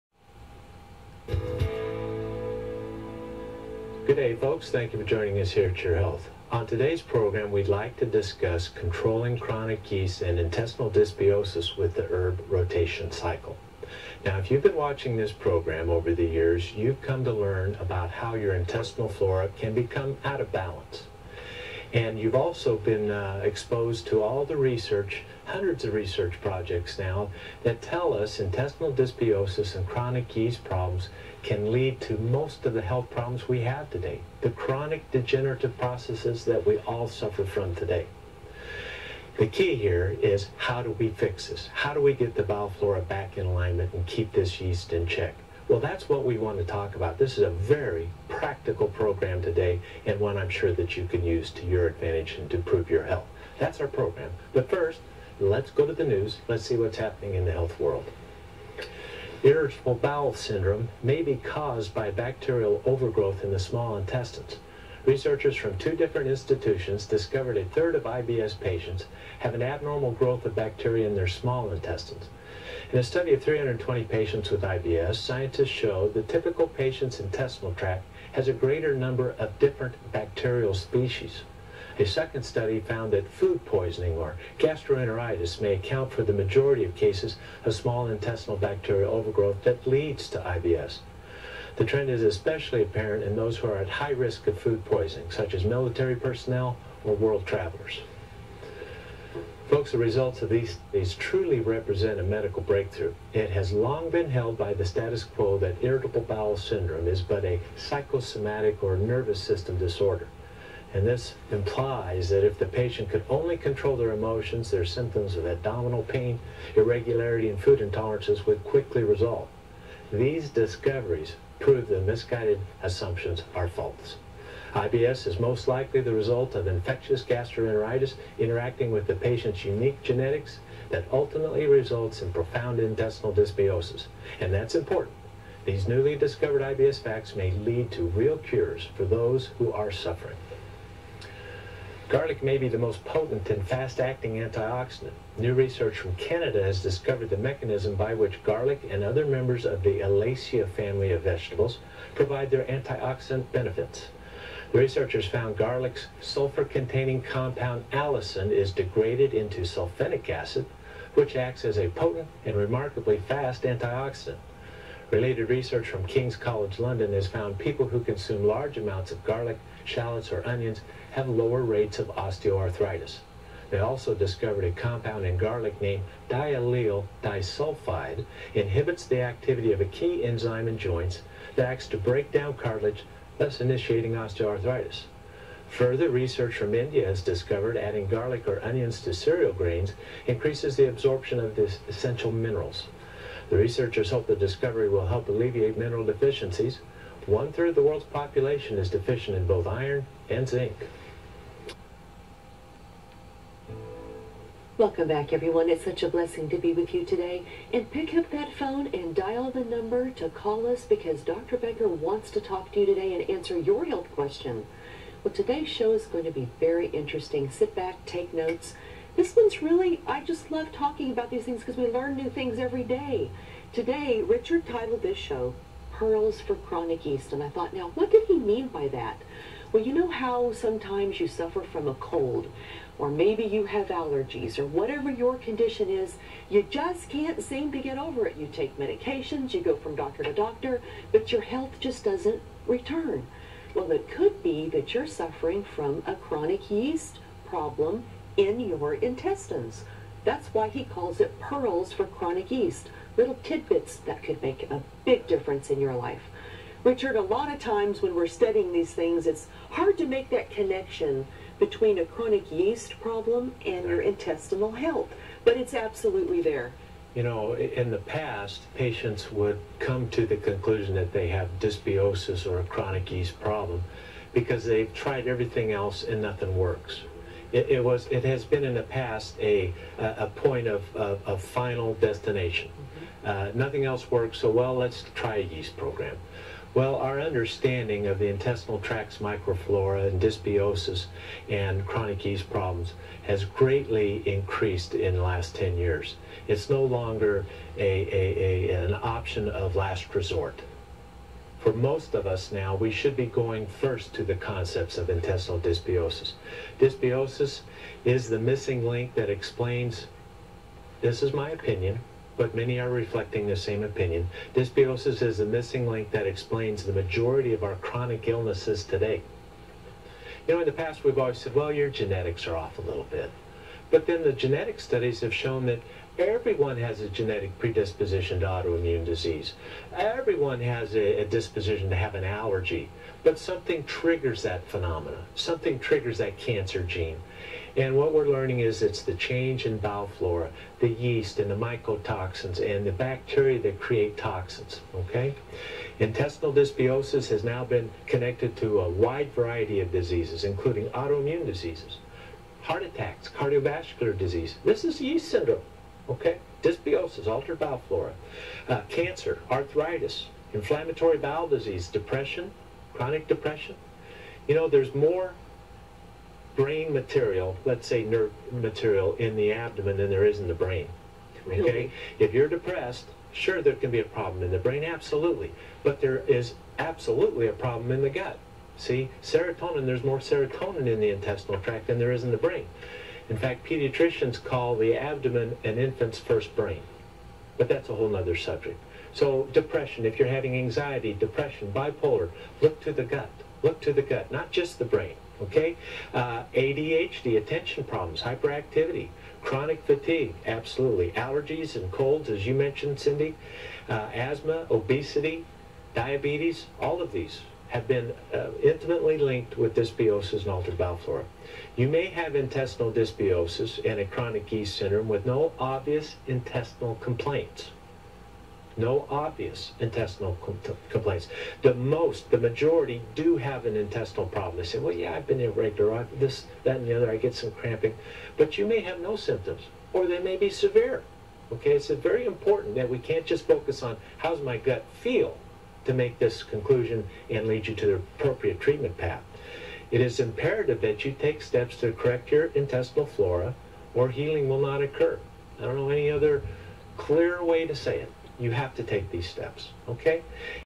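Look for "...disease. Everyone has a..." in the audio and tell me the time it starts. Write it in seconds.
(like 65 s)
329 s.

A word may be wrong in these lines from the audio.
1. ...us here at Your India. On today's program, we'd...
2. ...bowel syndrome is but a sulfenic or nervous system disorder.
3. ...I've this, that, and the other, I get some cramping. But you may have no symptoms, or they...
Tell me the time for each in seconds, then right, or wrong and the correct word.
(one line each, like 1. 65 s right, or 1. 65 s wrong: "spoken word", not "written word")
1. 5 s wrong: "Health", not "India"
2. 106 s wrong: "psychosomatic", not "sulfenic"
3. 425 s right.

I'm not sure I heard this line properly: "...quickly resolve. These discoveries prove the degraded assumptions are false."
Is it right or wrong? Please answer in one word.
wrong.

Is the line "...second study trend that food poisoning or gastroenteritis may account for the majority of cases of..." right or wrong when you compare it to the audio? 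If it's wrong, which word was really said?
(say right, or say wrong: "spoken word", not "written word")
wrong: "found", not "trend".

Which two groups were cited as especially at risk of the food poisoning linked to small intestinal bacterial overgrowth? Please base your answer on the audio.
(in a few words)
military personnel or world travelers.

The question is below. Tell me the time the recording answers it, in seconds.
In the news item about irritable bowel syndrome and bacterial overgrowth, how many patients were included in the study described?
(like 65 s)
73 s.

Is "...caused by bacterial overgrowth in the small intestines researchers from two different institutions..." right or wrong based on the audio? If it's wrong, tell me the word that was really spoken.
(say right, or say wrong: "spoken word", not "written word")
right.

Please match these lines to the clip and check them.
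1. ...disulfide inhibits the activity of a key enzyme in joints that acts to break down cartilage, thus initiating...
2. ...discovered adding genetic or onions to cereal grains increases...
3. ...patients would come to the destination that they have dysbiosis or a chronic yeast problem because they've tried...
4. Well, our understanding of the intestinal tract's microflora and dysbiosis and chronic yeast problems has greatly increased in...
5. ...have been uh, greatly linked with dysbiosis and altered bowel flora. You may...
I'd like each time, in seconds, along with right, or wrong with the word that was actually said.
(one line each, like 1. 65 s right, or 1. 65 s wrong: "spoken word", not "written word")
1. 177 s right
2. 187 s wrong: "garlic", not "genetic"
3. 268 s wrong: "conclusion", not "destination"
4. 286 s right
5. 407 s wrong: "intimately", not "greatly".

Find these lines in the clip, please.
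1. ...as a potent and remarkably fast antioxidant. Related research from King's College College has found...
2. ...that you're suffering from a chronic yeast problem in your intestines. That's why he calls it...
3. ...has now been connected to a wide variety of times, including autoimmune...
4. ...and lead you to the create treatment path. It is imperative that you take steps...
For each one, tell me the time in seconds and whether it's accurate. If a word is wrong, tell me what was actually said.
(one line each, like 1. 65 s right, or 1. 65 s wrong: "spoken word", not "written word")
1. 161 s wrong: "London", not "College"
2. 244 s right
3. 347 s wrong: "diseases", not "times"
4. 437 s wrong: "appropriate", not "create".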